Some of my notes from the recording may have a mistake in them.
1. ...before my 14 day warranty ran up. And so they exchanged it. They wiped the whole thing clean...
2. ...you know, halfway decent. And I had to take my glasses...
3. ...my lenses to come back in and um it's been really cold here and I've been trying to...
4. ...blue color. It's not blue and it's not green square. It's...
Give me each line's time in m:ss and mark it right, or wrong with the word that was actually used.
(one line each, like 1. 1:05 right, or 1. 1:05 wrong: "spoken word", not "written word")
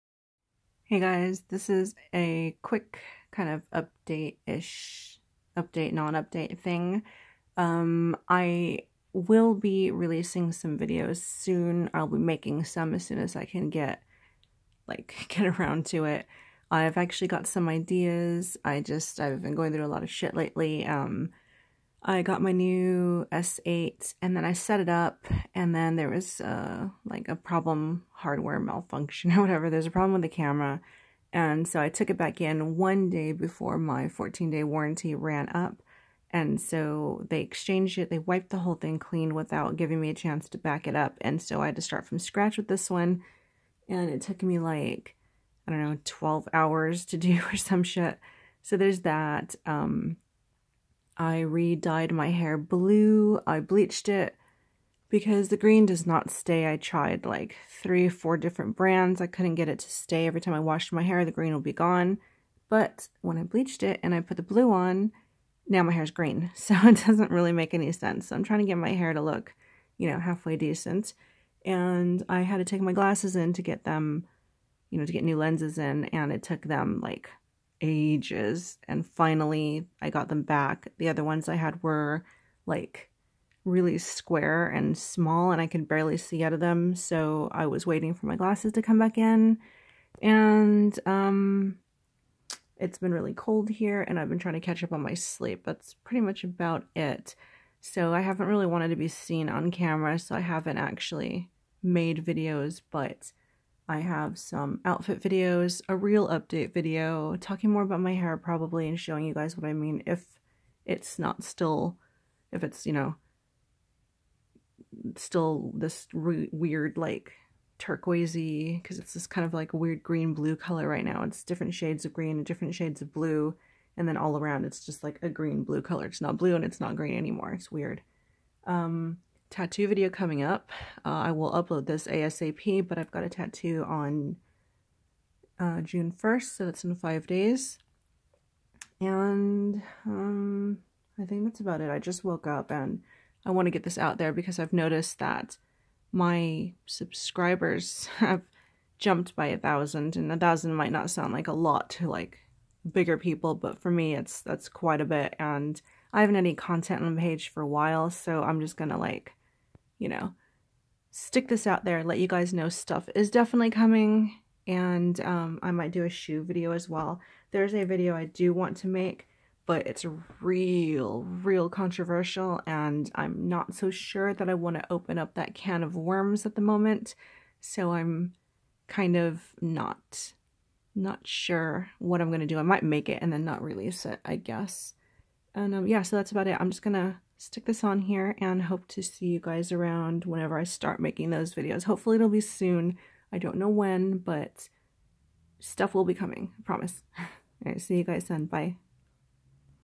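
1. 0:33 right
2. 1:09 right
3. 1:28 wrong: "glasses", not "lenses"
4. 2:05 wrong: "anymore", not "square".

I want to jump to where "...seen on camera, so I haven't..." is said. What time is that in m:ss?
1:39.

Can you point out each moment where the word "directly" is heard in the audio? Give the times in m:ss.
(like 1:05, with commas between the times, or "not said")
not said.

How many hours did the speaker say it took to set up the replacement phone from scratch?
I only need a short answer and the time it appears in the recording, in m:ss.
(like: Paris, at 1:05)
12, at 0:46.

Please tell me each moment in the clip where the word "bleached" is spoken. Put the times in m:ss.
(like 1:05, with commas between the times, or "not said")
0:53, 1:03.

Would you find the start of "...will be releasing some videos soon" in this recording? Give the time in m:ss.
0:09.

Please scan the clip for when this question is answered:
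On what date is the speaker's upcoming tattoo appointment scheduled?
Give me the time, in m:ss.
2:15.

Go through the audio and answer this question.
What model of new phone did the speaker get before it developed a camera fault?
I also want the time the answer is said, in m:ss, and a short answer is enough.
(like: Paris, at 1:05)
S8, at 0:23.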